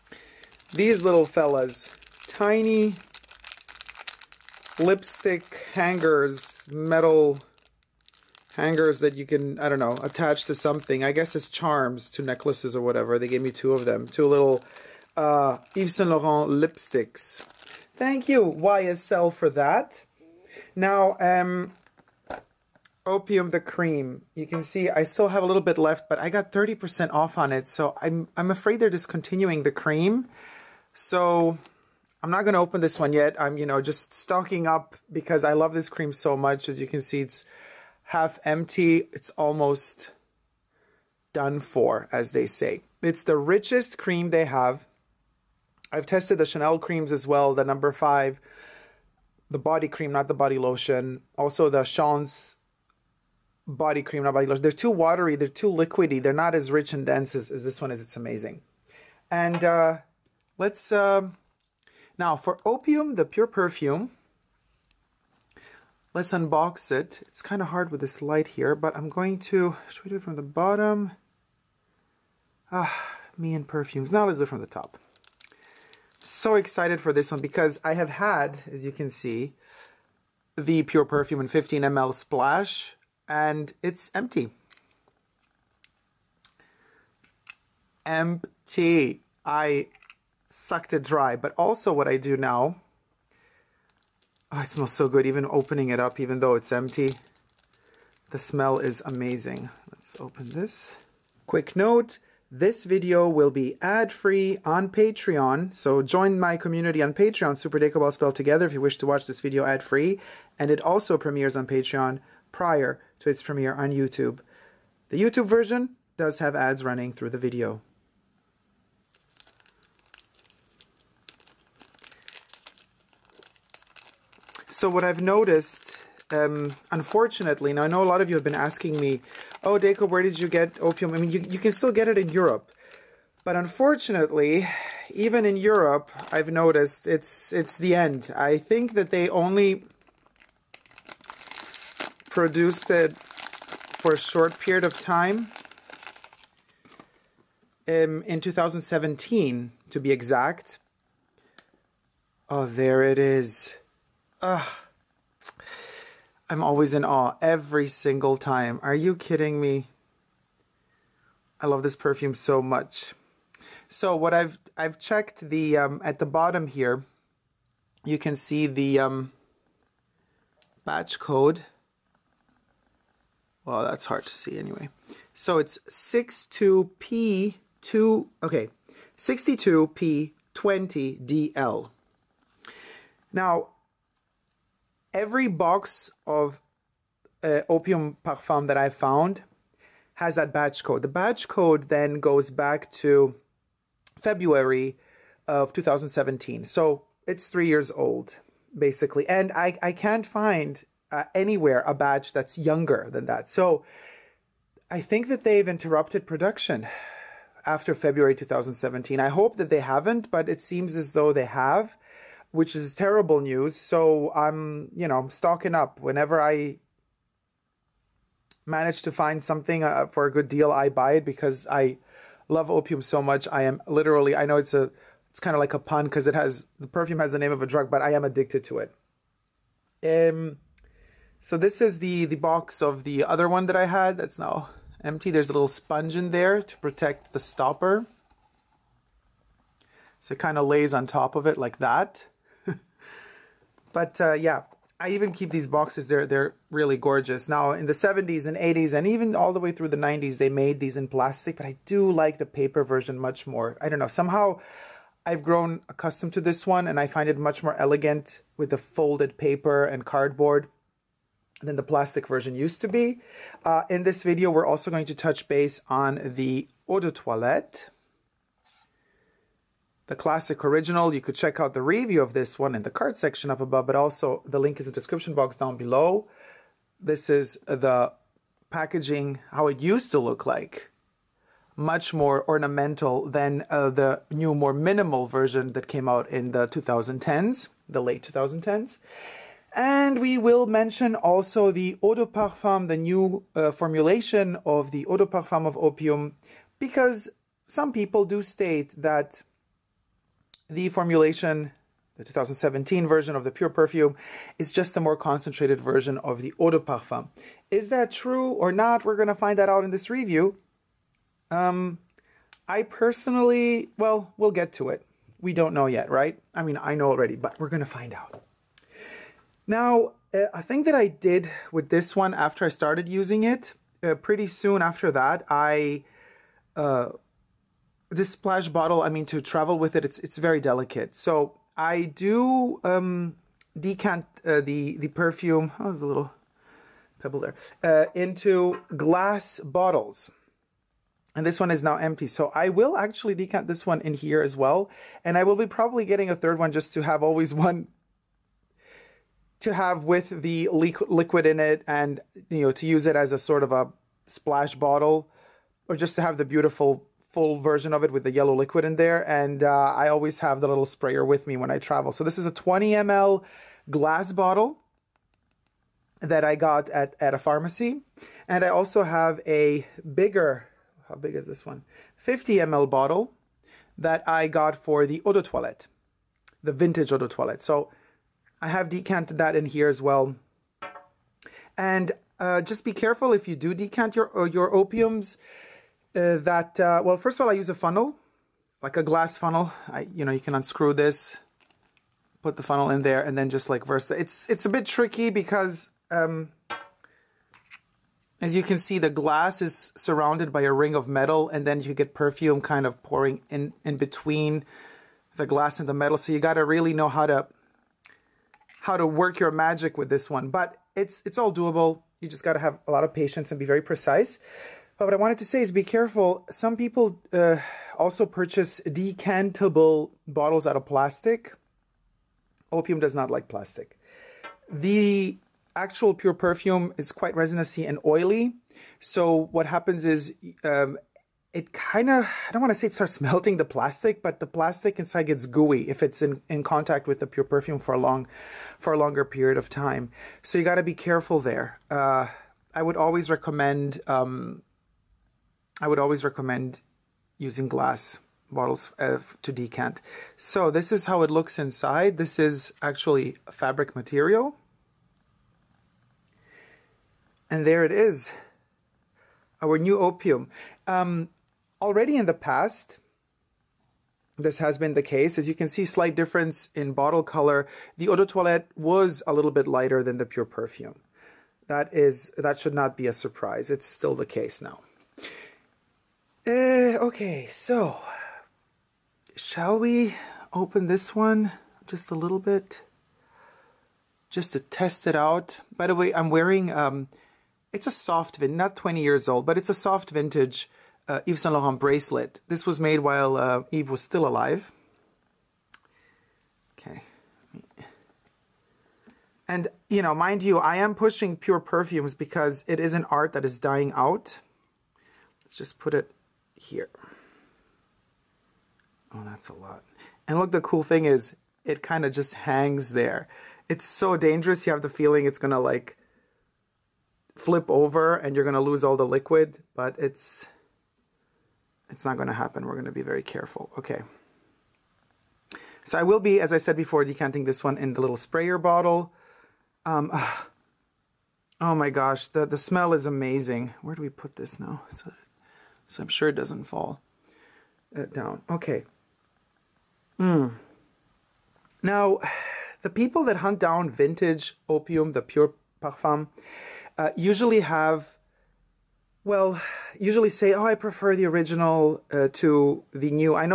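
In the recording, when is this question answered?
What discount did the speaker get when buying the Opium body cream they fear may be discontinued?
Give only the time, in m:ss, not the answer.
0:26.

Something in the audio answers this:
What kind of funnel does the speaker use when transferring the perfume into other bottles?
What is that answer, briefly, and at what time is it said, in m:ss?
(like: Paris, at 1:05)
Glass funnel, at 6:29.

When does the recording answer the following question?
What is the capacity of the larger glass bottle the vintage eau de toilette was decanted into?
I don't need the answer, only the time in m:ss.
6:12.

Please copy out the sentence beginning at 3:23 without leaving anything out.
So I think that they've interrupted production after February 2017.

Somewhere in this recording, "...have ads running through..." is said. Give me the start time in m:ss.
1:56.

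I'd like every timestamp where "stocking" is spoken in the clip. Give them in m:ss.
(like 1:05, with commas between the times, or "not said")
0:34, 3:35.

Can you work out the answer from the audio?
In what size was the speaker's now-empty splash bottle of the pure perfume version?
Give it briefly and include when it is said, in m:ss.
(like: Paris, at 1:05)
15 ml, at 1:21.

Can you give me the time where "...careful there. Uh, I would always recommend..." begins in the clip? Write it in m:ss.
7:20.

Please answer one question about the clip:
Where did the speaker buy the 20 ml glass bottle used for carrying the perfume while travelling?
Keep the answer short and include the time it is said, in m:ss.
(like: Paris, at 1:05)
A pharmacy, at 6:07.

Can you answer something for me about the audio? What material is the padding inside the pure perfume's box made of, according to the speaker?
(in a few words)
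Fabric.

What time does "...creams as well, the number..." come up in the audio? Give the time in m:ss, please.
0:46.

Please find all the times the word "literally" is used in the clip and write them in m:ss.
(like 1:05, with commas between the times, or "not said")
3:43.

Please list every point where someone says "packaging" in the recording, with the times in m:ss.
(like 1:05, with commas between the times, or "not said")
4:38.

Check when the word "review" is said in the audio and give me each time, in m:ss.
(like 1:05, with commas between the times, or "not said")
4:31, 5:10.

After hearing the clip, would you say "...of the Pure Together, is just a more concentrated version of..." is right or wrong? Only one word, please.
wrong.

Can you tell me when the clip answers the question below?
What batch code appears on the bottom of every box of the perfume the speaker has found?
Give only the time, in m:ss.
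2:59.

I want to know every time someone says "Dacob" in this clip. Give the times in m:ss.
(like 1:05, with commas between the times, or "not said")
1:47, 2:09.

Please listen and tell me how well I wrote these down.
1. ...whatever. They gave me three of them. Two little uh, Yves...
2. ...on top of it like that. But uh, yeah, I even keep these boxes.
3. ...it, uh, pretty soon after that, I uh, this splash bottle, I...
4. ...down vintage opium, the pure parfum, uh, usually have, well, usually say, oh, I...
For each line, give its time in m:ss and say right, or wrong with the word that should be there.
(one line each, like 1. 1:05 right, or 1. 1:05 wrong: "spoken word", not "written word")
1. 0:12 wrong: "two", not "three"
2. 4:00 right
3. 5:23 right
4. 9:03 right.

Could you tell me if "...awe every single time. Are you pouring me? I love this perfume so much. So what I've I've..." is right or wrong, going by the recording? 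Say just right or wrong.
wrong.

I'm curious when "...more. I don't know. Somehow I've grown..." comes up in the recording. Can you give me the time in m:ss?
4:13.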